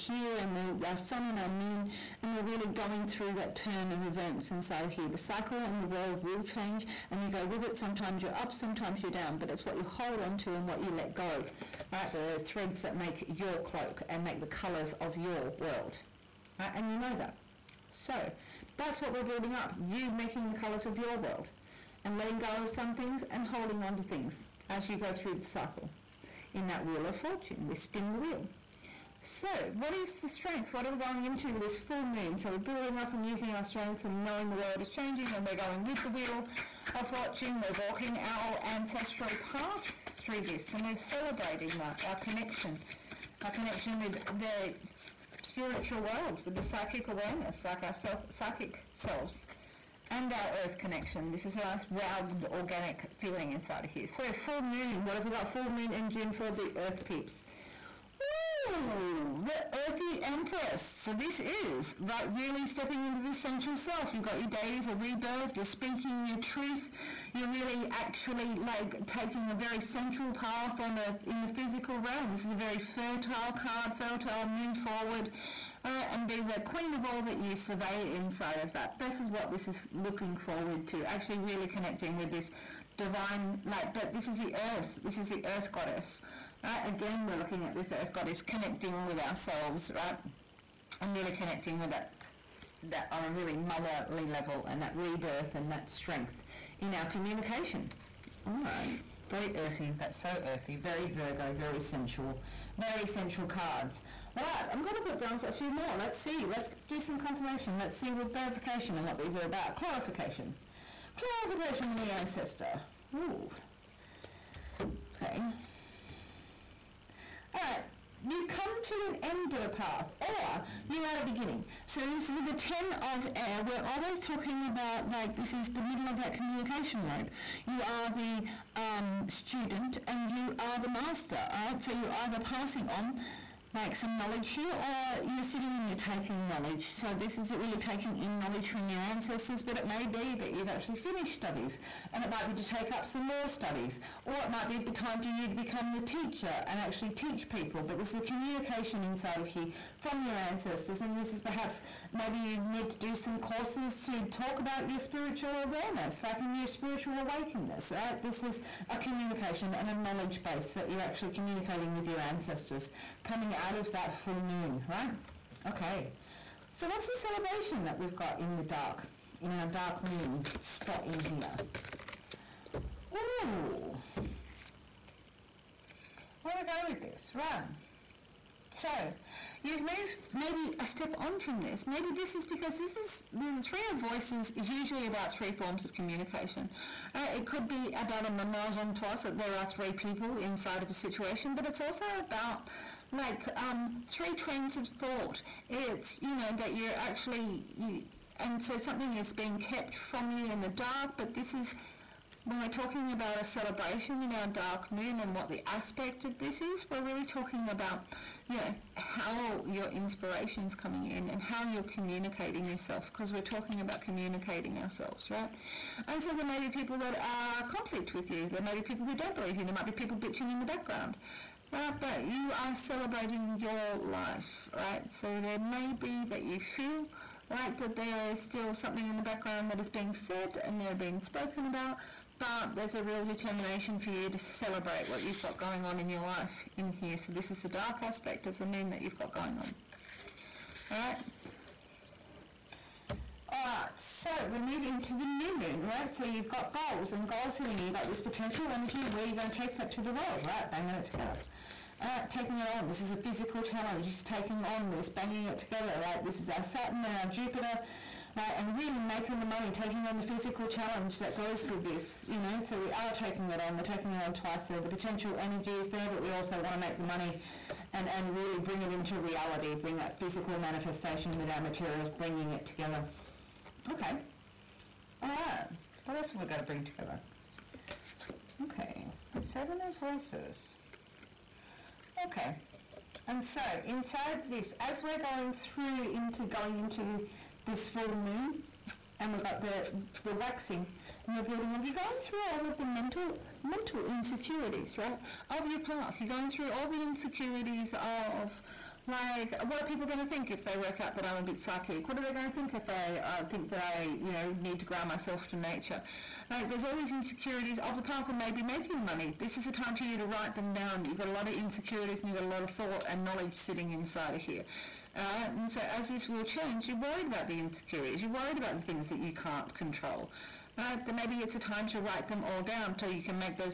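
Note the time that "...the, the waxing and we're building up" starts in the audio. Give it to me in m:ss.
4:49.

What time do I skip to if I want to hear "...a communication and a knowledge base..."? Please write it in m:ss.
2:38.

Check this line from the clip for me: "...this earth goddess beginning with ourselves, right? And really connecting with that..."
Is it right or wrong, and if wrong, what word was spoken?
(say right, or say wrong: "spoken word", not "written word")
wrong: "connecting", not "beginning".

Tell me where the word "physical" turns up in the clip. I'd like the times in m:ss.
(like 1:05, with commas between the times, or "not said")
1:11, 4:13, 4:20, 4:30.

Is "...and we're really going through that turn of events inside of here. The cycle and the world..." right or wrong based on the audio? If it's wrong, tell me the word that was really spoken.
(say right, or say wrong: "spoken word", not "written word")
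right.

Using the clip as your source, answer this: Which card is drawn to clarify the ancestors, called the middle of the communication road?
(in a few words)
Ten of Air.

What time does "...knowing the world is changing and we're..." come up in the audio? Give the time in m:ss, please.
0:34.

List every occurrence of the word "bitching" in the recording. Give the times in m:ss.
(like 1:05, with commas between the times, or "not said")
3:40.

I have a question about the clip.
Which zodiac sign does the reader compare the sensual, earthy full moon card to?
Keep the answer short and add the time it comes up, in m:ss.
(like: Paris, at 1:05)
Virgo, at 1:41.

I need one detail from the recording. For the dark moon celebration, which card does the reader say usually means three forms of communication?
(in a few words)
Three of Voices.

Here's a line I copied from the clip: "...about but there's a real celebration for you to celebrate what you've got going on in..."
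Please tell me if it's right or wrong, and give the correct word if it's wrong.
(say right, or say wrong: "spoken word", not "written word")
wrong: "determination", not "celebration".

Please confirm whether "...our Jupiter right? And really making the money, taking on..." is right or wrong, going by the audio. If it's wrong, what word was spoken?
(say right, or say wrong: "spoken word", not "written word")
right.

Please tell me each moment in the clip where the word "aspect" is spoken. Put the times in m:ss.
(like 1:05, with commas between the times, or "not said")
3:25, 3:58.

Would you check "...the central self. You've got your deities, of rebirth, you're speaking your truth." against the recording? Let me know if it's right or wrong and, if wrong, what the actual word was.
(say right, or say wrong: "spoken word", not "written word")
right.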